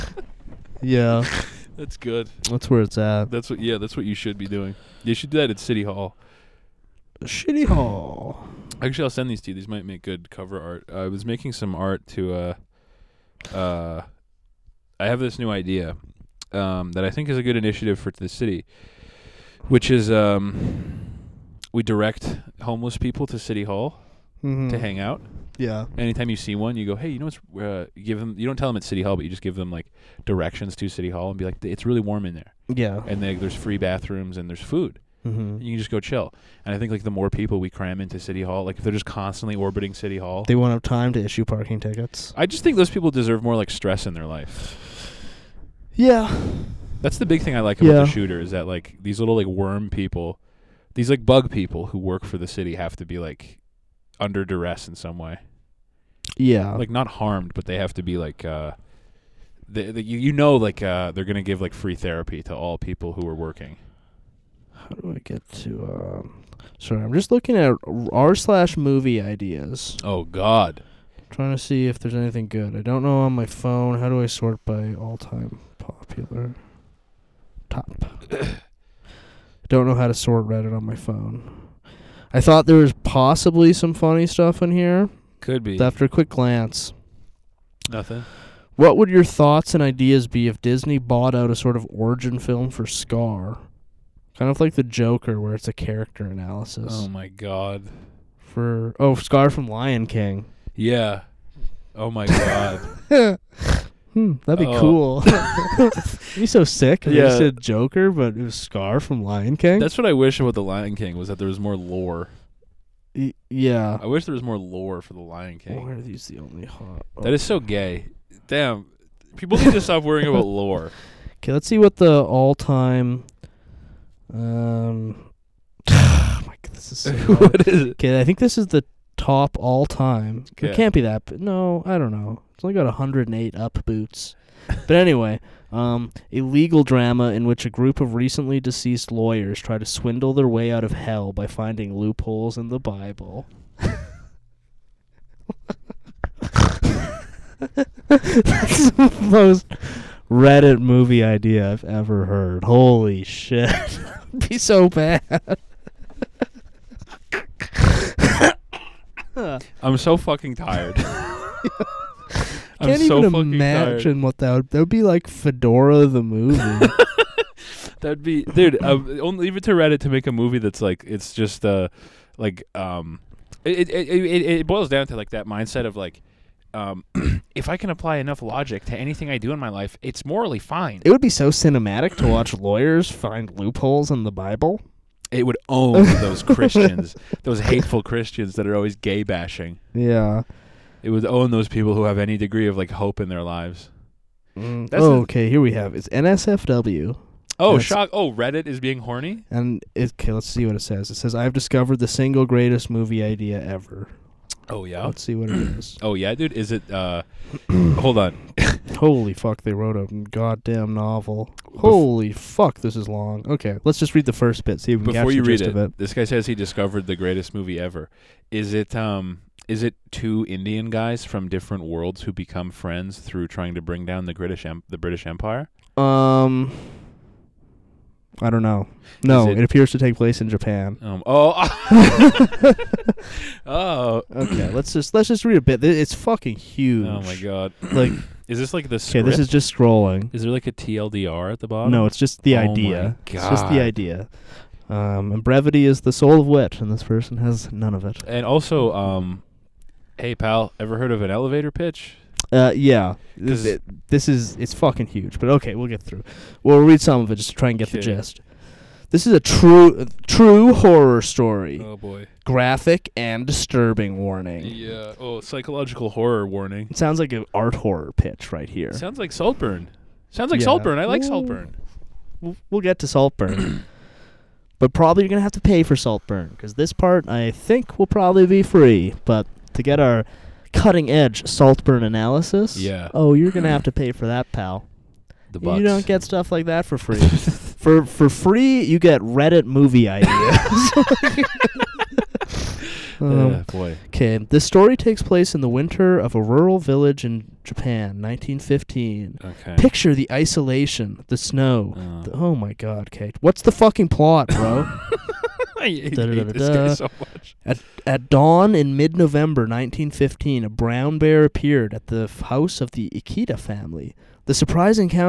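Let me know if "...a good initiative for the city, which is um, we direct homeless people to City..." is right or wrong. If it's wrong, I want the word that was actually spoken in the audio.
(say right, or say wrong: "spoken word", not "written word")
right.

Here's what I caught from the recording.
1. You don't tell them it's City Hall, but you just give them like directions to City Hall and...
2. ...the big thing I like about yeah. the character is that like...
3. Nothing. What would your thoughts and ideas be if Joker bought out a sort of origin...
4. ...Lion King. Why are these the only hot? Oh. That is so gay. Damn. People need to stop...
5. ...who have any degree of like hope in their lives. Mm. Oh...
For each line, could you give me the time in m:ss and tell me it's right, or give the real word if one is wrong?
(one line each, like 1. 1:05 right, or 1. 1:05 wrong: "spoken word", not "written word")
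1. 0:28 right
2. 0:47 wrong: "shooter", not "character"
3. 1:27 wrong: "Disney", not "Joker"
4. 1:55 right
5. 3:11 right.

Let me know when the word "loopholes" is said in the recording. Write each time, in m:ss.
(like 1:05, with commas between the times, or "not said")
2:21, 3:03.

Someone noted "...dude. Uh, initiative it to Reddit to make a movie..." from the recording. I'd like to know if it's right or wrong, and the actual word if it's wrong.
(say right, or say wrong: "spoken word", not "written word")
wrong: "leave", not "initiative".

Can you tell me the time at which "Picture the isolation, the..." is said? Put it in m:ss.
4:59.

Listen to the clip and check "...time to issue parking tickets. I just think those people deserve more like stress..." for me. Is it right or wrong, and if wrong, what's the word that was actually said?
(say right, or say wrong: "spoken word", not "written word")
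right.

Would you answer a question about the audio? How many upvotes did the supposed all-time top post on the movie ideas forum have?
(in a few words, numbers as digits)
108.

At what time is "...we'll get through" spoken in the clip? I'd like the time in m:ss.
4:15.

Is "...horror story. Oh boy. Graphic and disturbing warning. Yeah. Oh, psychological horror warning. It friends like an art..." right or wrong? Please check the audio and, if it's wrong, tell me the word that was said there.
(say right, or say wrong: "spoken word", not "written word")
wrong: "sounds", not "friends".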